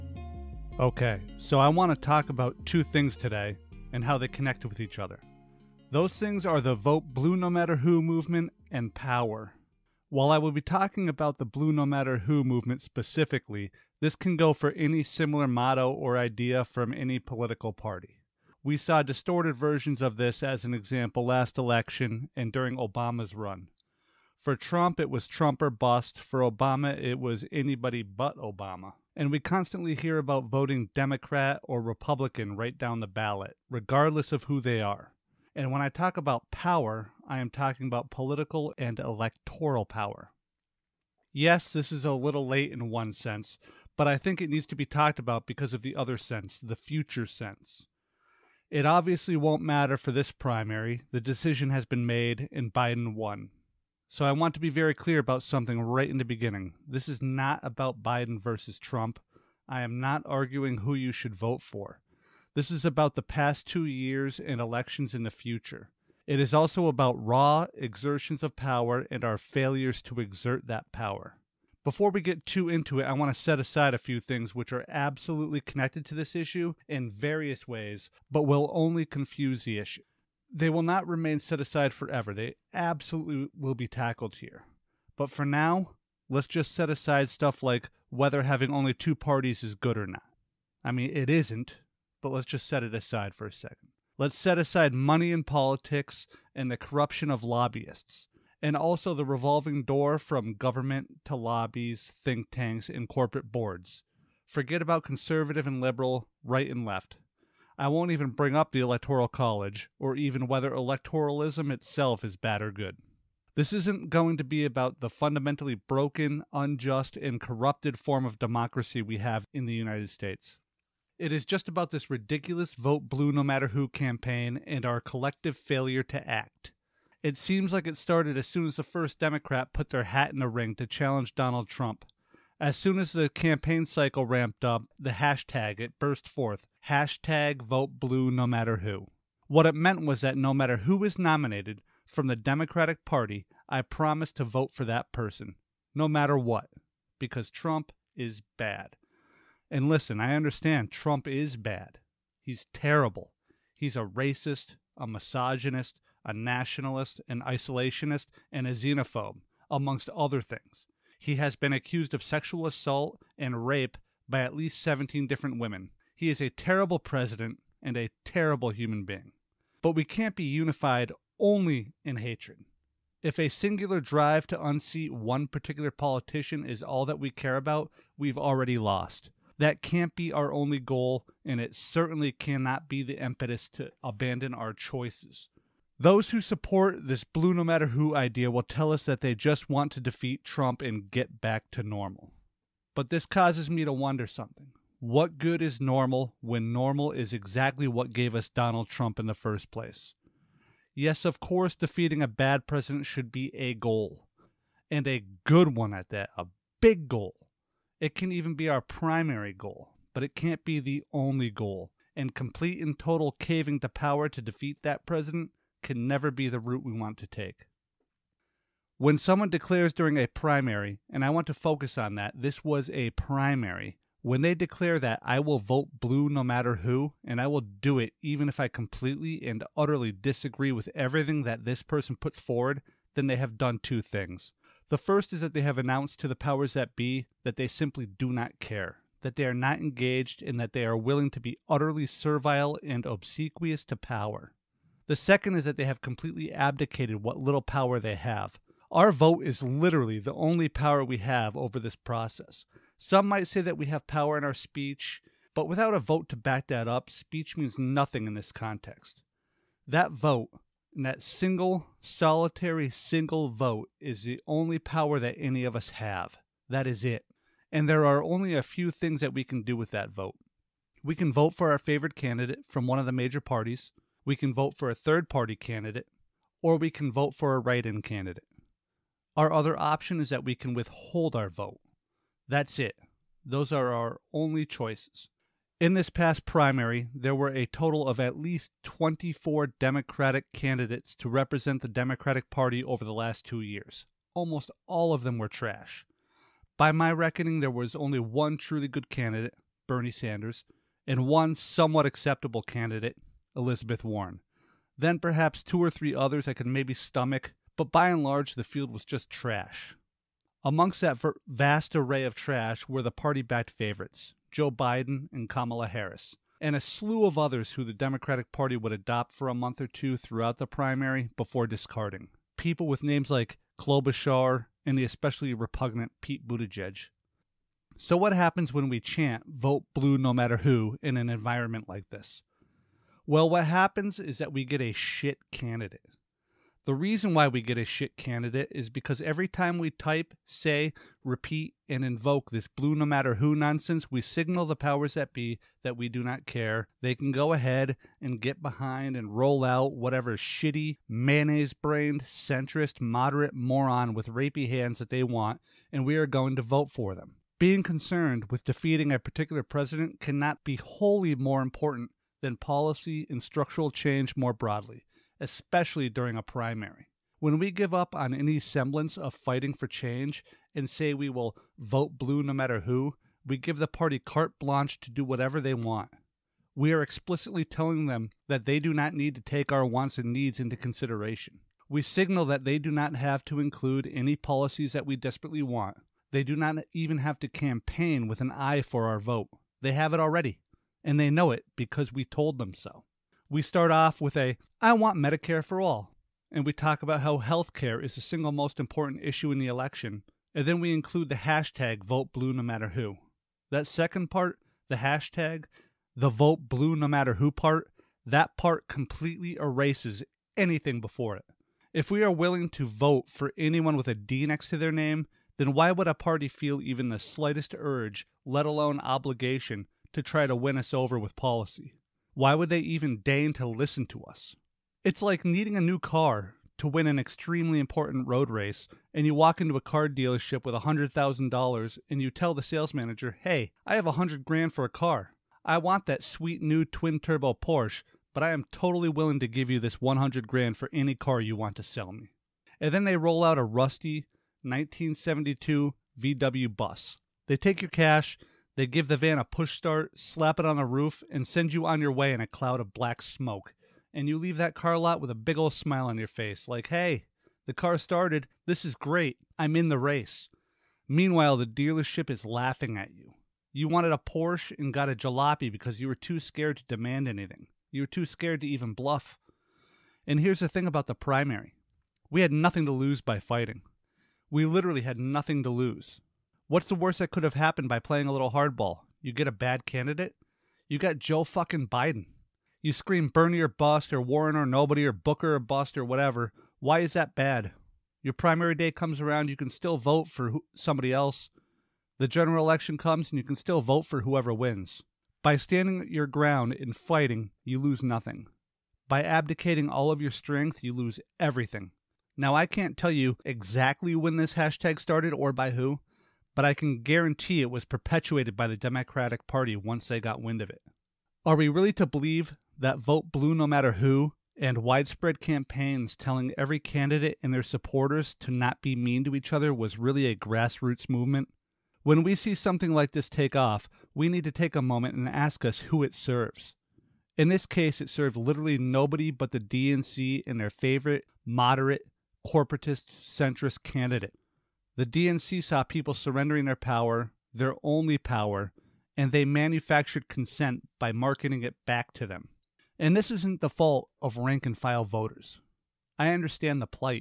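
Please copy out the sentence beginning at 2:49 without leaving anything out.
But we can't be unified only in hatred.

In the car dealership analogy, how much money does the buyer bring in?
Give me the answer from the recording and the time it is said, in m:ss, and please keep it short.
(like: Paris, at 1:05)
$100,000, at 7:10.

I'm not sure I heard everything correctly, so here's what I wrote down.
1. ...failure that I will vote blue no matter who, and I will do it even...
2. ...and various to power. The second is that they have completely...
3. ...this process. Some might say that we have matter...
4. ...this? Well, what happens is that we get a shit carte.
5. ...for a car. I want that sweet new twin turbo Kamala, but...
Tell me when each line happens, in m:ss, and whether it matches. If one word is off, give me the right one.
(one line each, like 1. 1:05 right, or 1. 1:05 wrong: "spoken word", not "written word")
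1. 3:44 wrong: "declare", not "failure"
2. 4:02 wrong: "obsequious", not "various"
3. 4:11 wrong: "power", not "matter"
4. 5:32 wrong: "candidate", not "carte"
5. 7:14 wrong: "Porsche", not "Kamala".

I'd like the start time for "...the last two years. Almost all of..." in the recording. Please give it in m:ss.
4:53.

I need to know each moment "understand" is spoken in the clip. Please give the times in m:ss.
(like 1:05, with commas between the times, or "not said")
2:30, 9:06.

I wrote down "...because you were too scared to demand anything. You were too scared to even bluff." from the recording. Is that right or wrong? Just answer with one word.
right.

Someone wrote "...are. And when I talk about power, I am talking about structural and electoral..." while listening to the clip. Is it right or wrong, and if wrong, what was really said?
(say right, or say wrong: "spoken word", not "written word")
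wrong: "political", not "structural".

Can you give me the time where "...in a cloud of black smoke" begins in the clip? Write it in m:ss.
7:32.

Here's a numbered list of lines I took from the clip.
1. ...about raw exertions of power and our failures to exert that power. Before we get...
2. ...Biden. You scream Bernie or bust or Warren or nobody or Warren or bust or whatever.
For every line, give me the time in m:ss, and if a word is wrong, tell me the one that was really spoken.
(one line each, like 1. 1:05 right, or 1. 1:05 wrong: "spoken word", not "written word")
1. 1:06 right
2. 8:01 wrong: "Booker", not "Warren".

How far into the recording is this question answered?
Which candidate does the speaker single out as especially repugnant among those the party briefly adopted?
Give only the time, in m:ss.
5:26.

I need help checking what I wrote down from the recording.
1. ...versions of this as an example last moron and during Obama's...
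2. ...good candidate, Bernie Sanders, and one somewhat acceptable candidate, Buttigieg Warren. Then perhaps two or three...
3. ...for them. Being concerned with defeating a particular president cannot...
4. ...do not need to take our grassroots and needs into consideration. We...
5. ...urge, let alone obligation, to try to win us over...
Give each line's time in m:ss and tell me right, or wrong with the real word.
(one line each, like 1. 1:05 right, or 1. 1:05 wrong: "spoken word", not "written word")
1. 0:19 wrong: "election", not "moron"
2. 4:58 wrong: "Elizabeth", not "Buttigieg"
3. 5:56 right
4. 6:18 wrong: "wants", not "grassroots"
5. 6:57 right.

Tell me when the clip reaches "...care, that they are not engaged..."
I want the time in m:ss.
3:58.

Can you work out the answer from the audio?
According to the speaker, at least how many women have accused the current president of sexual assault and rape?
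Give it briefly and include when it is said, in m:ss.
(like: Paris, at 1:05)
17, at 2:44.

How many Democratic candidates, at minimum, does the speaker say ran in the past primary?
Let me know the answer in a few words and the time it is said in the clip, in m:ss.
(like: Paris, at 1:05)
24, at 4:48.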